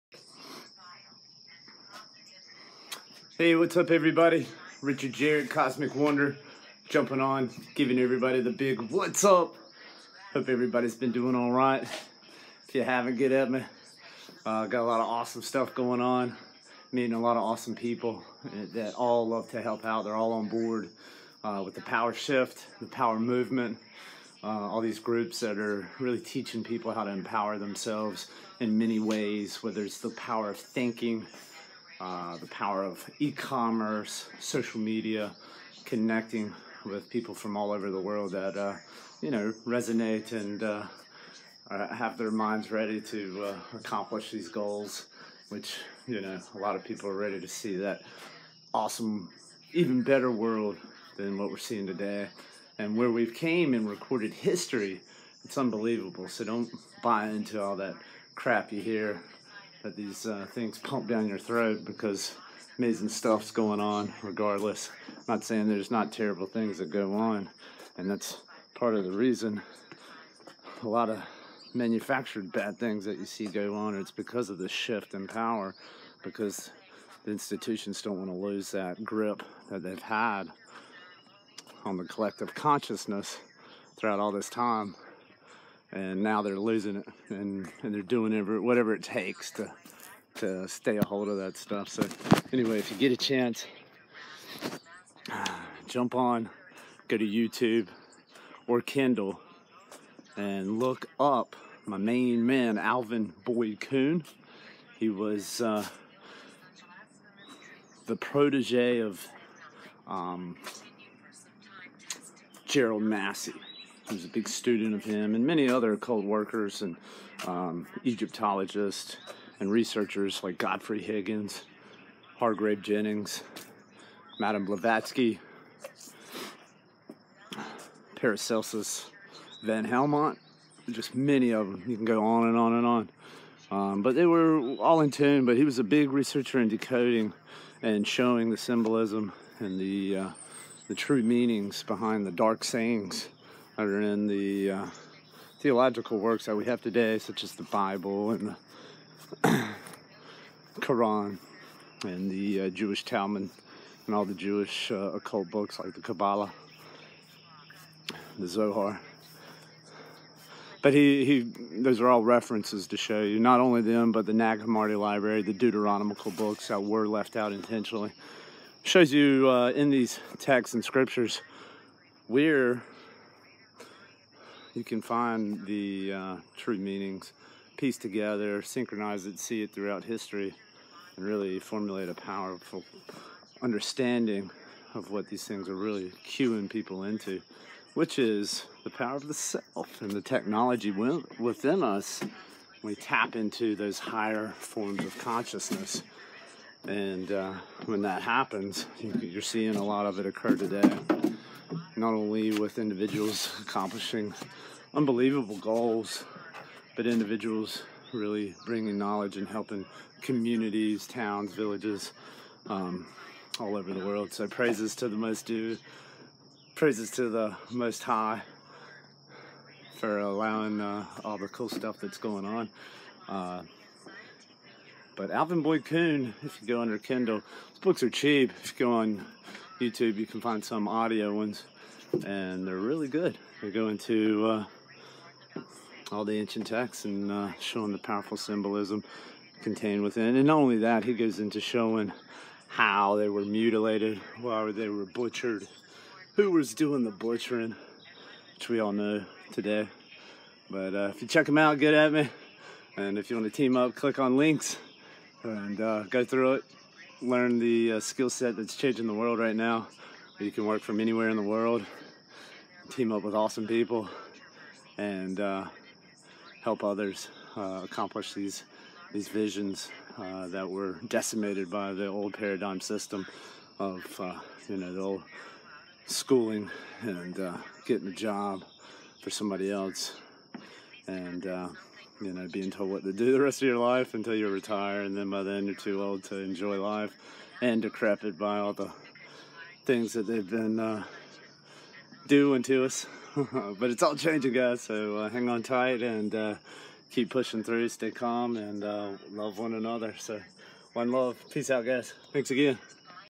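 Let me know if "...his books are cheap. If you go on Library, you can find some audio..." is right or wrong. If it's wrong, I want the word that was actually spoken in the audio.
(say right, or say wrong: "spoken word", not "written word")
wrong: "YouTube", not "Library".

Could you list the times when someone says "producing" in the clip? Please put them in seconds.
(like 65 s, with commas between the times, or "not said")
not said.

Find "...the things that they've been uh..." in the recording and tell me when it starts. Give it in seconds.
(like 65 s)
288 s.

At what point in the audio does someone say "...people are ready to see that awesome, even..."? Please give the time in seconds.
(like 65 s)
46 s.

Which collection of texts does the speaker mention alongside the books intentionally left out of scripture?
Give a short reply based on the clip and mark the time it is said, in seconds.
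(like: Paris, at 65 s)
Nag Hammadi Library, at 164 s.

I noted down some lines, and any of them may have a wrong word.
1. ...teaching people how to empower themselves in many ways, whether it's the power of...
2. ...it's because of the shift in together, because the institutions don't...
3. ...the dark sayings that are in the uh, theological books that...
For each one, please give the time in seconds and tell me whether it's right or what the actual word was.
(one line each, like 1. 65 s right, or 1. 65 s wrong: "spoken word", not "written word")
1. 26 s right
2. 73 s wrong: "power", not "together"
3. 142 s wrong: "works", not "books".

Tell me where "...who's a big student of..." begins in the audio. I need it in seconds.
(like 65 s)
114 s.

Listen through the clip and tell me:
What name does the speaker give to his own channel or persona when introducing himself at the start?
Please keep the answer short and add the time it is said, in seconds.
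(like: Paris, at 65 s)
Cosmic Wonder, at 5 s.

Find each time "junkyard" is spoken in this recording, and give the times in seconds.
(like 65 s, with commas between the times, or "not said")
not said.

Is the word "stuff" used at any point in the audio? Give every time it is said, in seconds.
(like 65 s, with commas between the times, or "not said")
15 s, 63 s, 91 s, 221 s.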